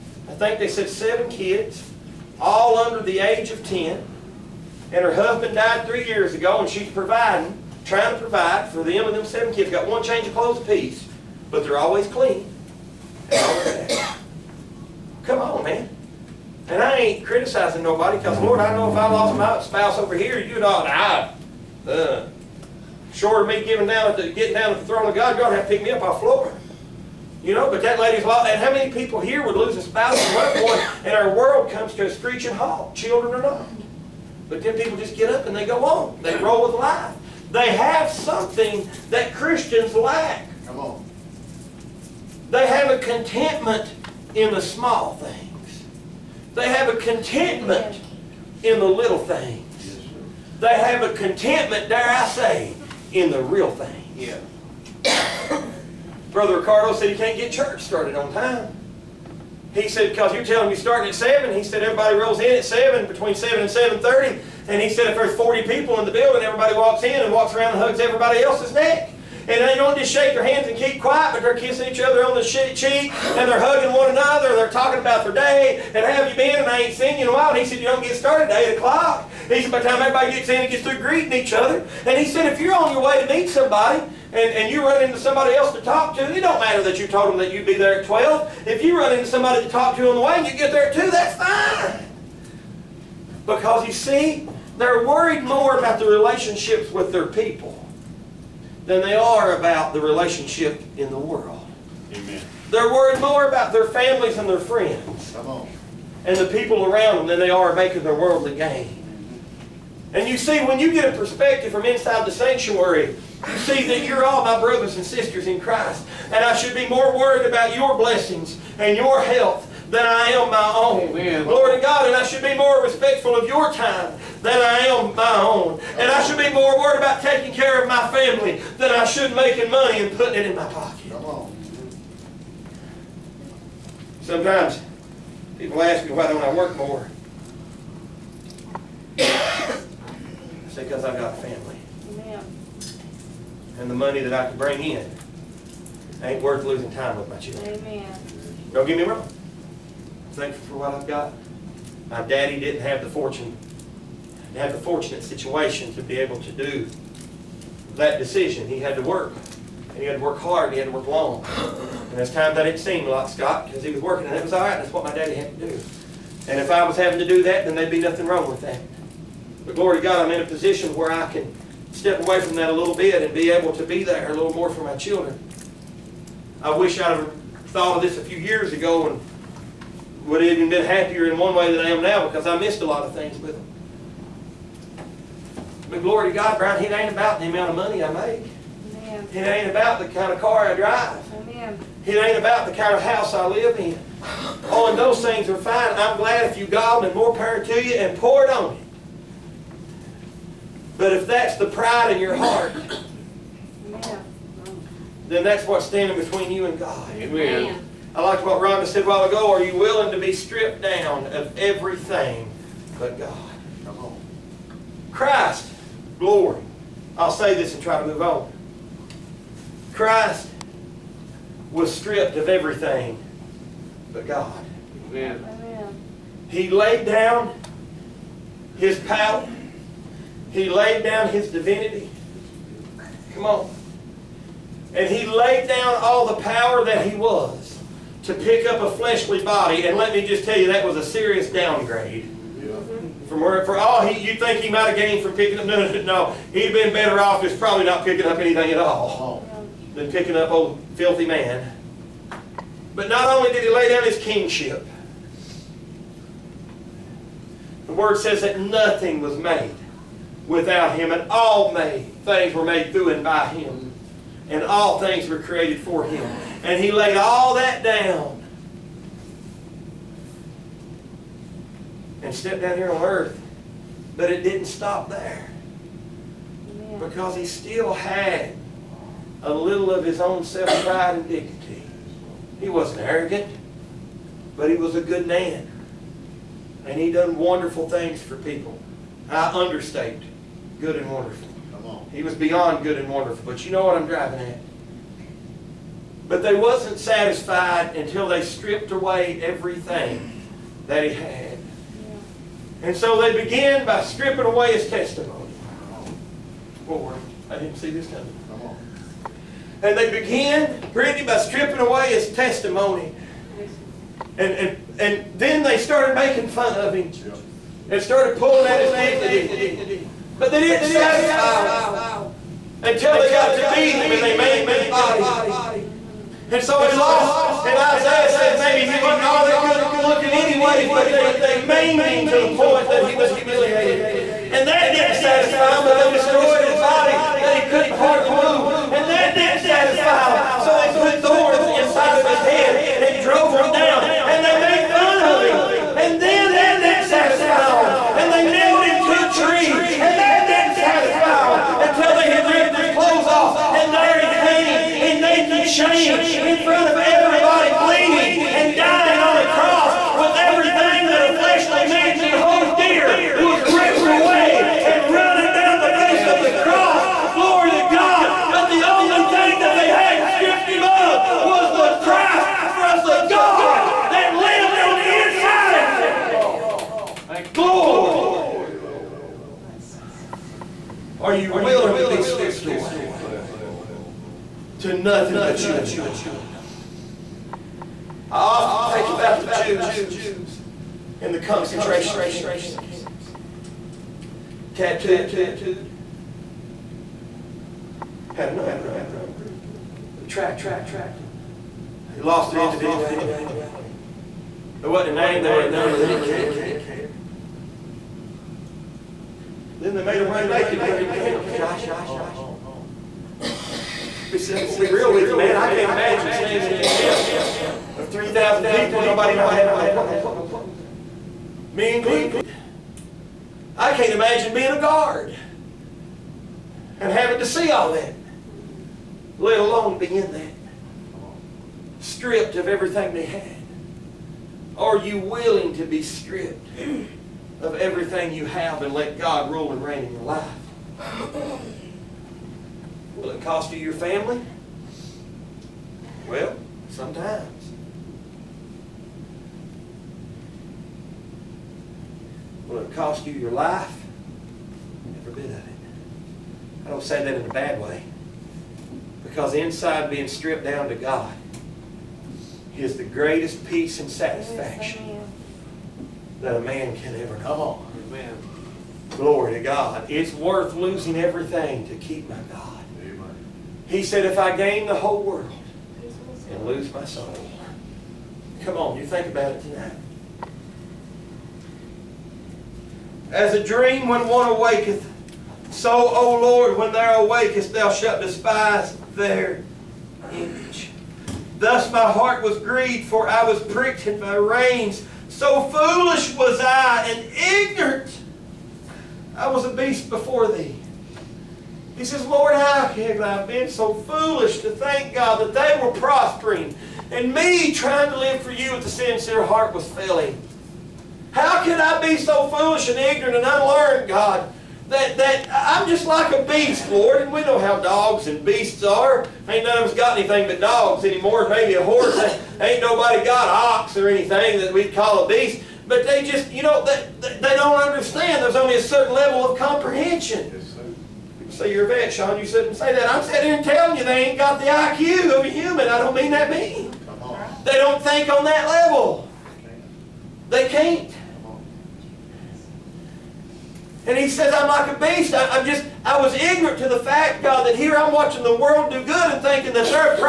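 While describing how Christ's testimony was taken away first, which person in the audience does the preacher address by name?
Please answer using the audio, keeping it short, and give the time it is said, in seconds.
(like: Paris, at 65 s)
Brittany, at 310 s.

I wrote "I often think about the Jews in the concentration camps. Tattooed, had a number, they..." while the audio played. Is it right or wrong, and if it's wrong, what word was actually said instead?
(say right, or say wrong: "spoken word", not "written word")
right.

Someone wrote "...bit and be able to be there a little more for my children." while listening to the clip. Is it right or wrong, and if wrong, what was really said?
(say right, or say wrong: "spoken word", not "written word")
right.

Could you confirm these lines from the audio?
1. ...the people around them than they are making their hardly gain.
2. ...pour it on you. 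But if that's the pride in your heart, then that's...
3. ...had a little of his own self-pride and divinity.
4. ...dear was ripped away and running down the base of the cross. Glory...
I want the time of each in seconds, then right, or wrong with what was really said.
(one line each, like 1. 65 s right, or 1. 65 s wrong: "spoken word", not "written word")
1. 106 s wrong: "worldly", not "hardly"
2. 198 s right
3. 277 s wrong: "dignity", not "divinity"
4. 362 s right.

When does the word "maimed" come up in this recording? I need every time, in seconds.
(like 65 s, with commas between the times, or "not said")
324 s, 331 s.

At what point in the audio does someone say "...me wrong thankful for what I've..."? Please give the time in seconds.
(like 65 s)
148 s.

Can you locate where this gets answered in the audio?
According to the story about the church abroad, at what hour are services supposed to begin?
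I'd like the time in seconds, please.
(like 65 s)
60 s.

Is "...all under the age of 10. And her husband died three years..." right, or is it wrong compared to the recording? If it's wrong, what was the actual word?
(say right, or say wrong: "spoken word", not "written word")
right.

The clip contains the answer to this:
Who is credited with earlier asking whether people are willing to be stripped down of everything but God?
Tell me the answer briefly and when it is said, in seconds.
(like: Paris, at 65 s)
Rhonda, at 208 s.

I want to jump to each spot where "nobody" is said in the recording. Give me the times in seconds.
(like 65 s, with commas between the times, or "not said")
17 s, 419 s, 522 s.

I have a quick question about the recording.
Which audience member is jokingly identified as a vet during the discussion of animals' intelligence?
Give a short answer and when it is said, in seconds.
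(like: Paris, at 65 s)
Sean, at 532 s.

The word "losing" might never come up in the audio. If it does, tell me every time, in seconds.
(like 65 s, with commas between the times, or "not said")
146 s, 470 s.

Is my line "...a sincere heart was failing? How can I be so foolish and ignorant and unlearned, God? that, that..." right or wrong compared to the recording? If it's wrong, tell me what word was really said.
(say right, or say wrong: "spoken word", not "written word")
right.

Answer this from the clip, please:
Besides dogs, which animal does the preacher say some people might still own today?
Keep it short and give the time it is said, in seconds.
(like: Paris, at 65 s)
A horse, at 521 s.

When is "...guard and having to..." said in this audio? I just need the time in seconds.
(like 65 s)
424 s.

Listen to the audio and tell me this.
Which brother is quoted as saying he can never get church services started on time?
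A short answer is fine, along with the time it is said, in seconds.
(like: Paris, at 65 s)
Ricardo, at 56 s.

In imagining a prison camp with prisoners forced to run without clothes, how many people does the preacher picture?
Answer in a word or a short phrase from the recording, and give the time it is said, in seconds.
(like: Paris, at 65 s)
3,000, at 418 s.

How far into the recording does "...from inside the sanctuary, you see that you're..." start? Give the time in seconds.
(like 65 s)
111 s.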